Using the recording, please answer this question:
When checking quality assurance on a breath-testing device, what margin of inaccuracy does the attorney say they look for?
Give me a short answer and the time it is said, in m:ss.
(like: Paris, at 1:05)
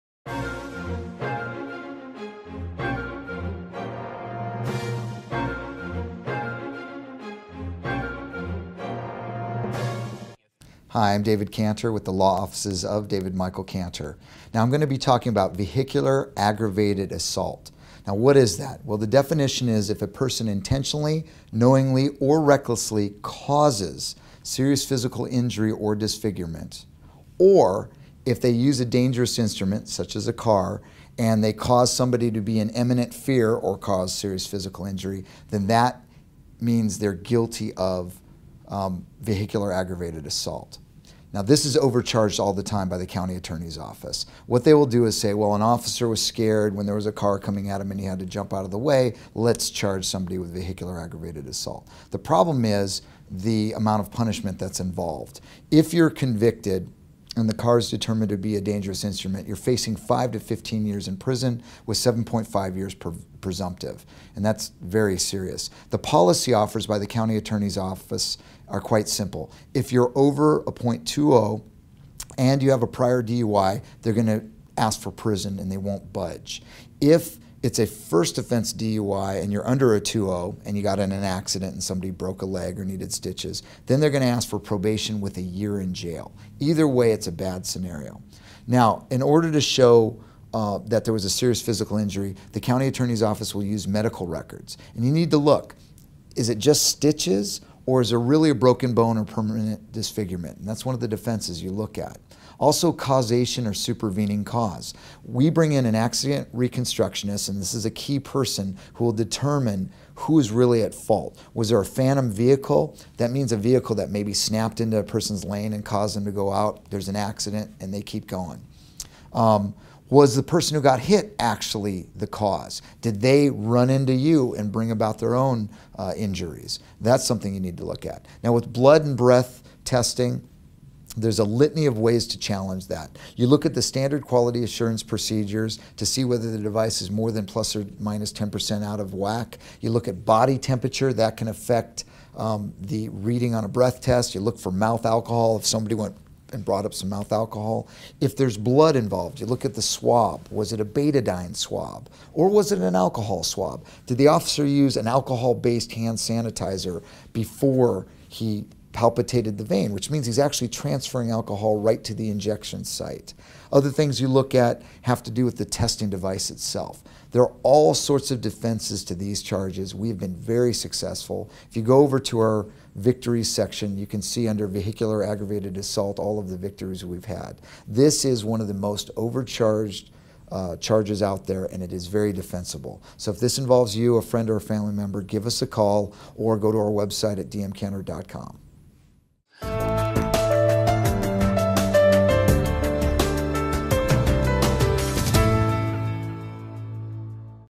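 plus or minus 10%, at 2:17.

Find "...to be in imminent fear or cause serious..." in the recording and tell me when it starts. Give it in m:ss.
0:32.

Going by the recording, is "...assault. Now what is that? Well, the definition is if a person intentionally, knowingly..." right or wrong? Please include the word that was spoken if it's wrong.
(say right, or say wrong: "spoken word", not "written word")
right.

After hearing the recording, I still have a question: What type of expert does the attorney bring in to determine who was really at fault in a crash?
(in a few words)
accident reconstructionist.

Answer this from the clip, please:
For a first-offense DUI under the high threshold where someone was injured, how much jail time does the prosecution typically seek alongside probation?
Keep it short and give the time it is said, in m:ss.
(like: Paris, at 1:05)
a year, at 1:25.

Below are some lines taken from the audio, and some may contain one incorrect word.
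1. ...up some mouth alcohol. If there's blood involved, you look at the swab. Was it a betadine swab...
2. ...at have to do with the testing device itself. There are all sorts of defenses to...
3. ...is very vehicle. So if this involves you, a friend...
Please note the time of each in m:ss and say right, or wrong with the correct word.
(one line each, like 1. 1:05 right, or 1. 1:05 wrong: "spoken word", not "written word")
1. 2:26 right
2. 2:44 right
3. 3:01 wrong: "defensible", not "vehicle".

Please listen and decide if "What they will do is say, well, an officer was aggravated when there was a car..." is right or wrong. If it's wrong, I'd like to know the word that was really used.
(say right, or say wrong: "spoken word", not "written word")
wrong: "scared", not "aggravated".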